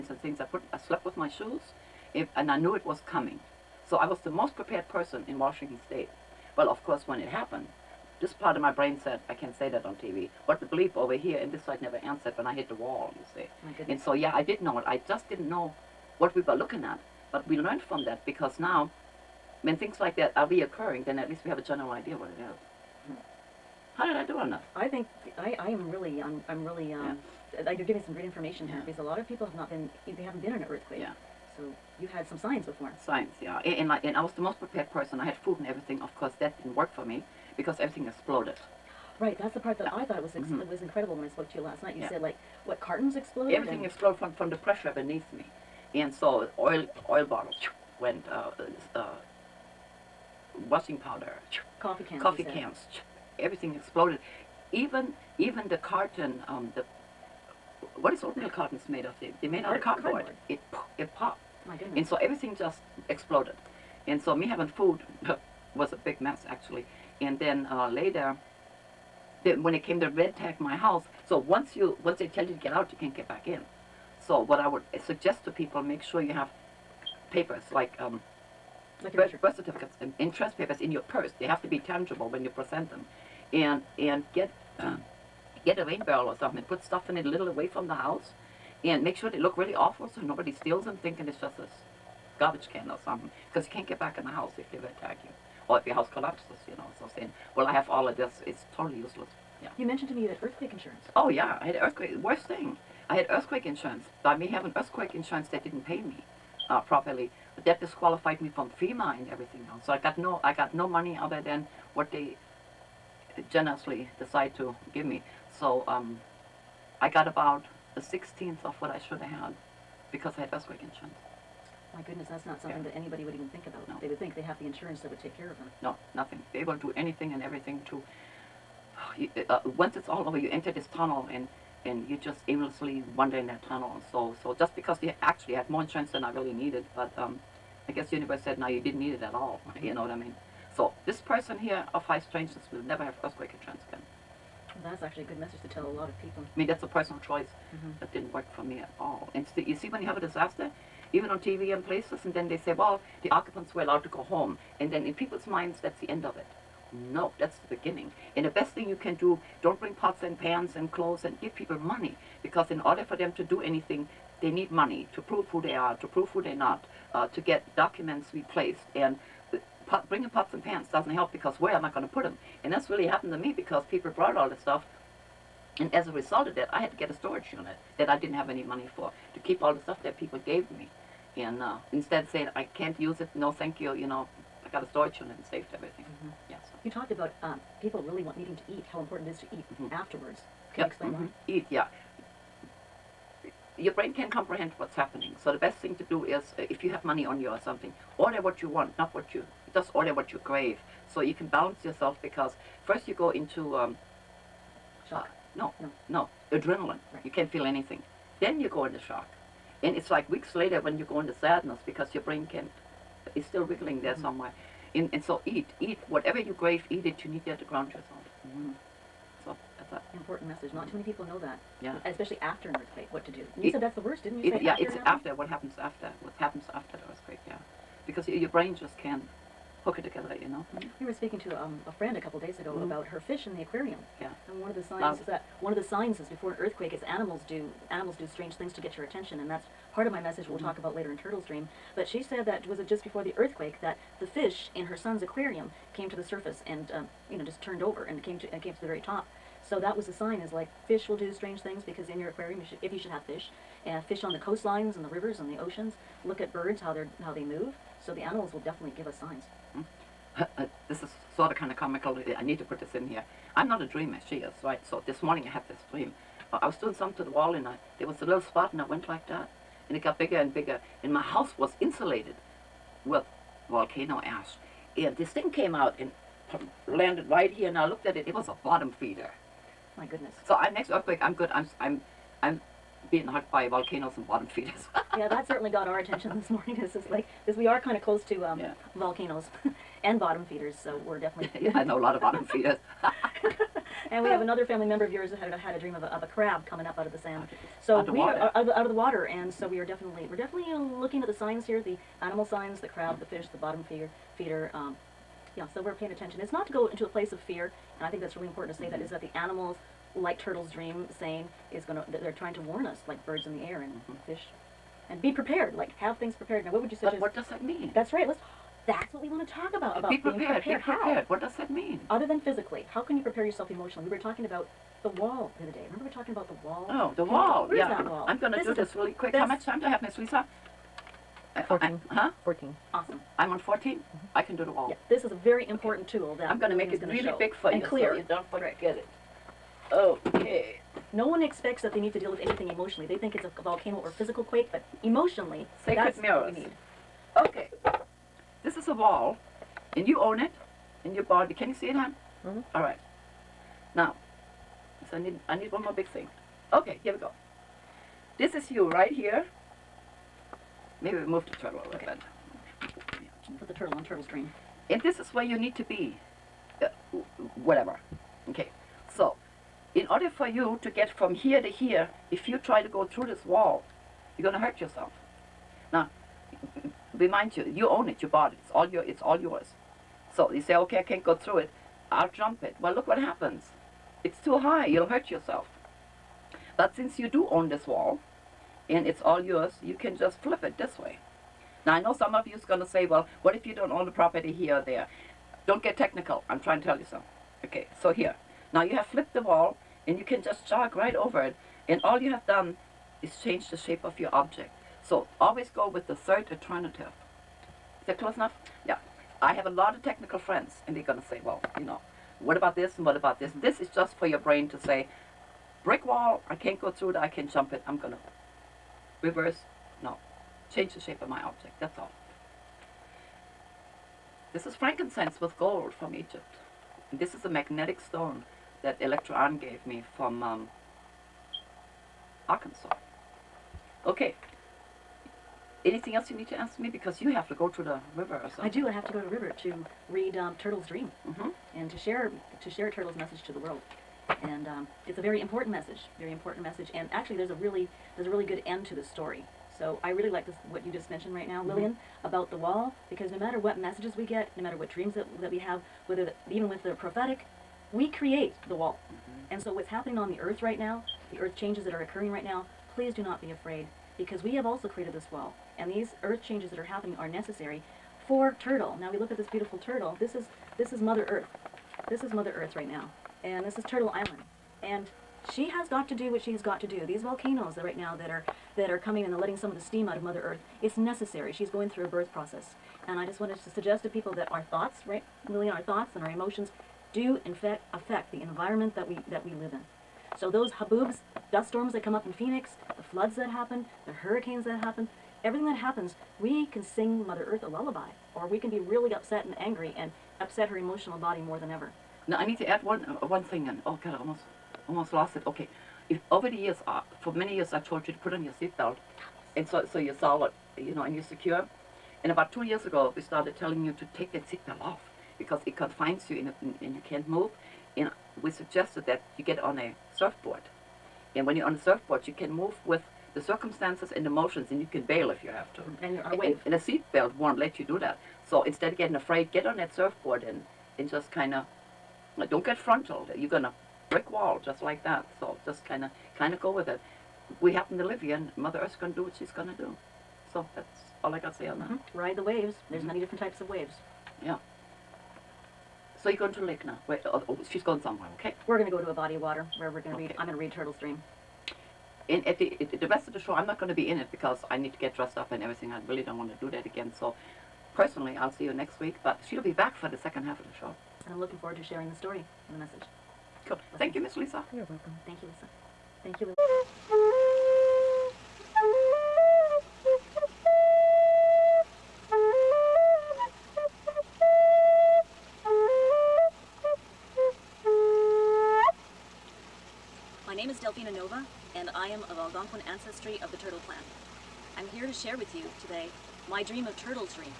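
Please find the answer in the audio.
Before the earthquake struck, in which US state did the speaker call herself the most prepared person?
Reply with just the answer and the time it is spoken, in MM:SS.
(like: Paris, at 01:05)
Washington State, at 00:05.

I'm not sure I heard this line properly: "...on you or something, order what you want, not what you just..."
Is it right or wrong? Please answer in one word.
right.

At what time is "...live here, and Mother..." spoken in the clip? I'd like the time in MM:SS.
08:58.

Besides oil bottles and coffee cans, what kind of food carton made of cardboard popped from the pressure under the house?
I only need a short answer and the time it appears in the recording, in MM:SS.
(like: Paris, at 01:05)
Oatmeal cartons, at 00:58.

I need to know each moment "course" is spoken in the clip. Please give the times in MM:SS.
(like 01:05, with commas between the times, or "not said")
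00:06, 00:36.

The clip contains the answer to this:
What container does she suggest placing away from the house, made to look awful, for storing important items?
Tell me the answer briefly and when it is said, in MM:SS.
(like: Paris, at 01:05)
A rain barrel, at 01:25.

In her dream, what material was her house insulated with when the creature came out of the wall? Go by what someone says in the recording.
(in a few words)
Volcano ash.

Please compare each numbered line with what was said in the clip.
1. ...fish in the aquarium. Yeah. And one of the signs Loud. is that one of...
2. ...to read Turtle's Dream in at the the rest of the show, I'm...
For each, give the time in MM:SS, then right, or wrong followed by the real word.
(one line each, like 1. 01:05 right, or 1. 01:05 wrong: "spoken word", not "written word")
1. 03:53 right
2. 09:10 right.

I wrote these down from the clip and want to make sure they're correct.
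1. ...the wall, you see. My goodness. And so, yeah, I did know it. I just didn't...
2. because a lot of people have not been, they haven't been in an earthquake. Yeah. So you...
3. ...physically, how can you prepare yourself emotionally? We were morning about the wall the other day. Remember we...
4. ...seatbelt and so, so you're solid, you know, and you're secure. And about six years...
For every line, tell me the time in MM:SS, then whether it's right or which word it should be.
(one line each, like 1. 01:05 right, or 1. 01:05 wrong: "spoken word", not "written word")
1. 00:12 right
2. 00:28 right
3. 05:22 wrong: "talking", not "morning"
4. 08:28 wrong: "two", not "six".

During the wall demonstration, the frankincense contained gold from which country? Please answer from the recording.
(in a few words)
Egypt.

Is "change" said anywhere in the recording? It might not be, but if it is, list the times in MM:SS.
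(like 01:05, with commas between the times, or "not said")
06:43, 07:00, 07:41, 07:46.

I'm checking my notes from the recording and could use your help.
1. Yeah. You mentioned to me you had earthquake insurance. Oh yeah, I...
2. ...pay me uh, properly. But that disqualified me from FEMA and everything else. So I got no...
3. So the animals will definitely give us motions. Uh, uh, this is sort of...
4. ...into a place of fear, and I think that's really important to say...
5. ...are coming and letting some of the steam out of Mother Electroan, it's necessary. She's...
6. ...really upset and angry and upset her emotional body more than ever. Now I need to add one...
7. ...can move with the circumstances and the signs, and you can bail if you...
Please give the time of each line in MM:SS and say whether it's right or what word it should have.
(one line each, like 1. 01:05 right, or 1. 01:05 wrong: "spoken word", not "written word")
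1. 01:39 right
2. 01:45 right
3. 04:18 wrong: "signs", not "motions"
4. 05:06 right
5. 07:58 wrong: "Earth", not "Electroan"
6. 08:18 right
7. 08:42 wrong: "motions", not "signs".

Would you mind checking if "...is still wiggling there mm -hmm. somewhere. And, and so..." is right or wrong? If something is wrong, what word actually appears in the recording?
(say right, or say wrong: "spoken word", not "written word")
right.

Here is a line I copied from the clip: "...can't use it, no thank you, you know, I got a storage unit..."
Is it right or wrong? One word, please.
right.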